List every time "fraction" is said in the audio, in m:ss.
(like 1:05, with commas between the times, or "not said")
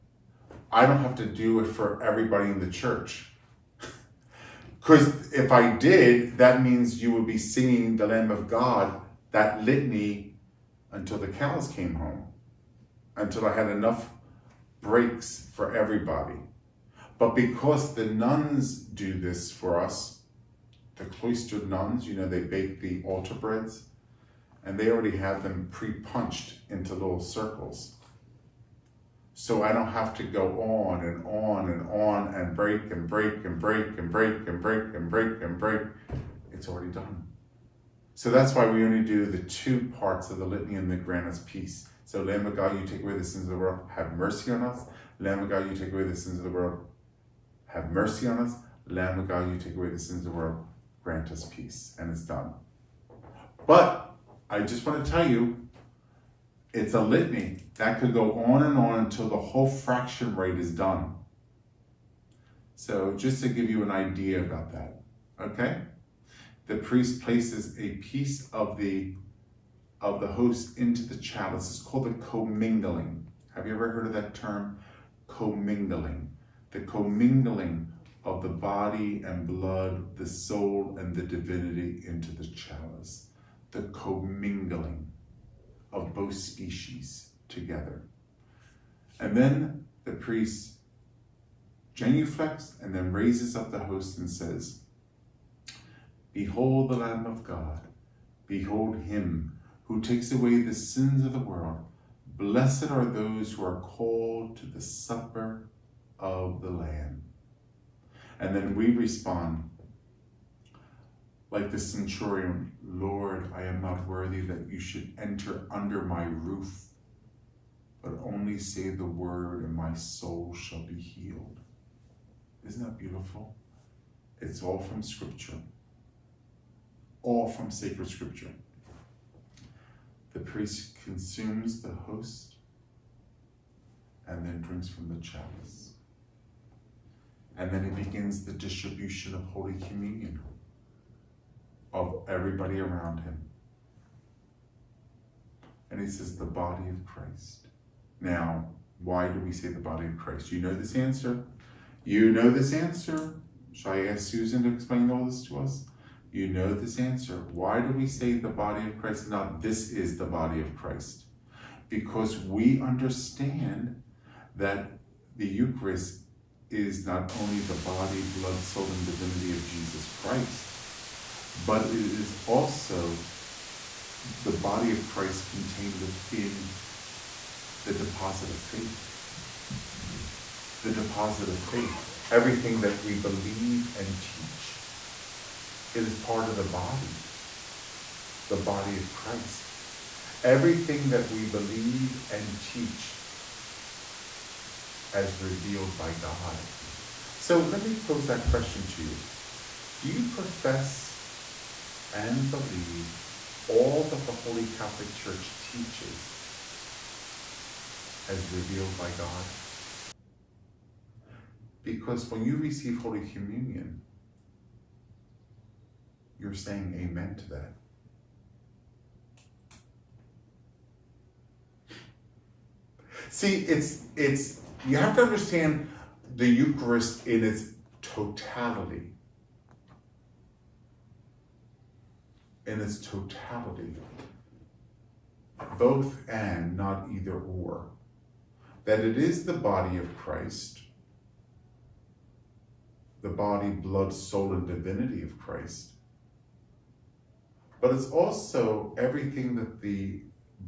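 0:59.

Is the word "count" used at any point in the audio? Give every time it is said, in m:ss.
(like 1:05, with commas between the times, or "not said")
not said.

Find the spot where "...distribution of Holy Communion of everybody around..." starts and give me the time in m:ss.
2:18.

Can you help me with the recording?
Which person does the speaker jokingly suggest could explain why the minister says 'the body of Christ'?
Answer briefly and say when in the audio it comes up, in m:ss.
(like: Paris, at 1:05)
Susan, at 2:34.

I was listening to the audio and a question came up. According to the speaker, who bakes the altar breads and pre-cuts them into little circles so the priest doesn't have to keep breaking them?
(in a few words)
Cloistered nuns.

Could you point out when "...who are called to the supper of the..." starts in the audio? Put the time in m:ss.
1:43.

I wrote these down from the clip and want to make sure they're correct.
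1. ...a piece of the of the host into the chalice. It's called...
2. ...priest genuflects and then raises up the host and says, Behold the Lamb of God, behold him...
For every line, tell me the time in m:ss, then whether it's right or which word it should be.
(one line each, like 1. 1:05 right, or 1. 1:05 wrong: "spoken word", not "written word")
1. 1:07 right
2. 1:30 right.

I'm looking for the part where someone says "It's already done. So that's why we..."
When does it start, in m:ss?
0:36.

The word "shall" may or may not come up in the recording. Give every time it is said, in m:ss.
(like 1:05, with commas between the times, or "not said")
2:00, 2:33.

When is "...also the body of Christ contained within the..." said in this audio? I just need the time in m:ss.
2:52.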